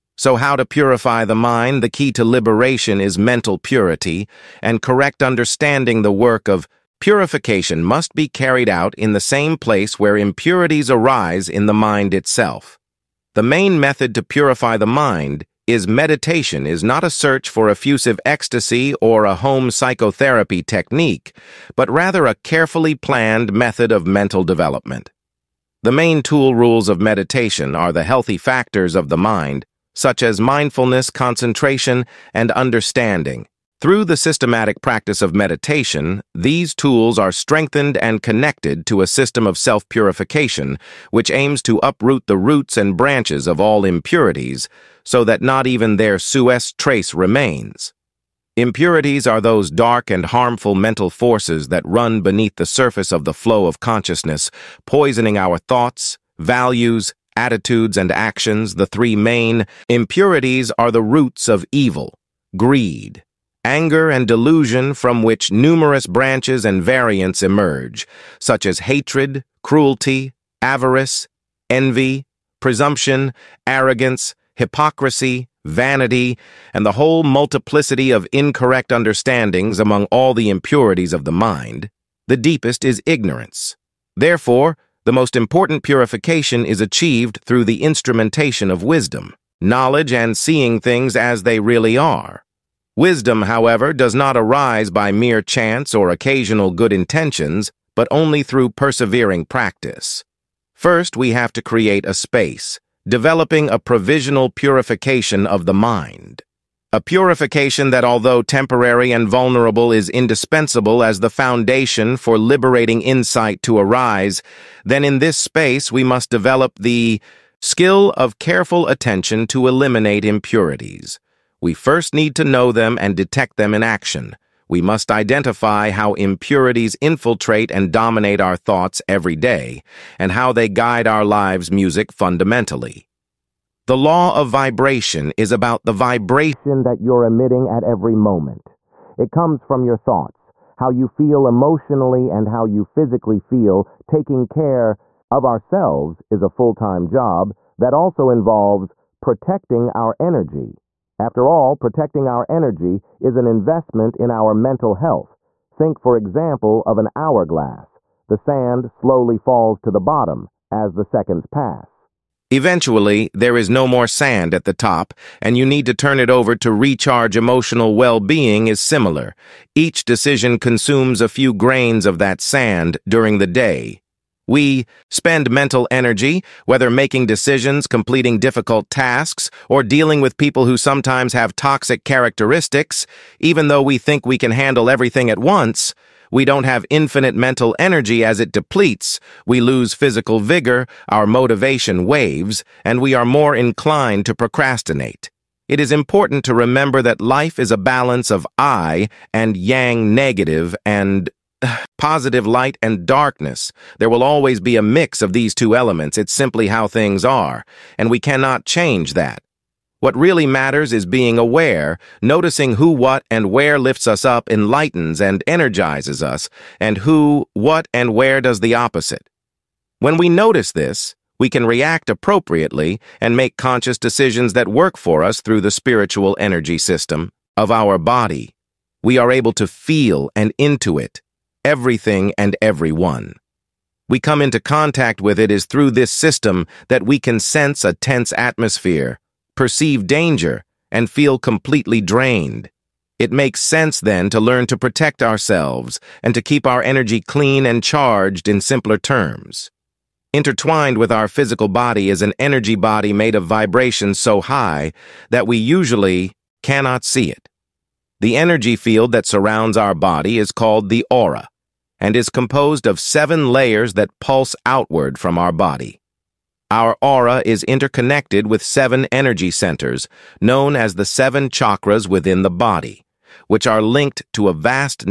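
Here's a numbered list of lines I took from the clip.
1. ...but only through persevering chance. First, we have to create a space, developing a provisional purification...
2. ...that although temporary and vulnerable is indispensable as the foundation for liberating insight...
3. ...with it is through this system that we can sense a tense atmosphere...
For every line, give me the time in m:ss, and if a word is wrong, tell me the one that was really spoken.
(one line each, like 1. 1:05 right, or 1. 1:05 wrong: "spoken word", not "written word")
1. 1:37 wrong: "practice", not "chance"
2. 1:47 right
3. 3:55 right.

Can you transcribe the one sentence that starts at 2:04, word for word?
We must identify how impurities infiltrate and dominate our thoughts every day, and how they guide our lives' music fundamentally.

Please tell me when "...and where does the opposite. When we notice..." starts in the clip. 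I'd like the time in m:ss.
3:37.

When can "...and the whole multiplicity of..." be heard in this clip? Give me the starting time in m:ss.
1:16.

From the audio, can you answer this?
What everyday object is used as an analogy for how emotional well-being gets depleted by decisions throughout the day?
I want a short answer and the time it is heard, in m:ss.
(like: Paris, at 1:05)
an hourglass, at 2:37.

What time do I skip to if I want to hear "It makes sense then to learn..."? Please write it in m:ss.
4:03.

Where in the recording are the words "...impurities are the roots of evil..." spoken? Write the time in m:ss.
0:59.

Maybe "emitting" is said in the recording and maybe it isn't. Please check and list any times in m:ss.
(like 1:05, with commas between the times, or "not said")
2:17.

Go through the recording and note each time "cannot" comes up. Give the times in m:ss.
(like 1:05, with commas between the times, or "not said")
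3:28, 4:16.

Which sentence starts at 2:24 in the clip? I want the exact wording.
Taking care of ourselves is a full-time job that also involves protecting our energy.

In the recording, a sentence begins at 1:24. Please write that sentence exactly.
Therefore, the most important purification is achieved through the instrumentation of wisdom, knowledge and seeing things as they really are.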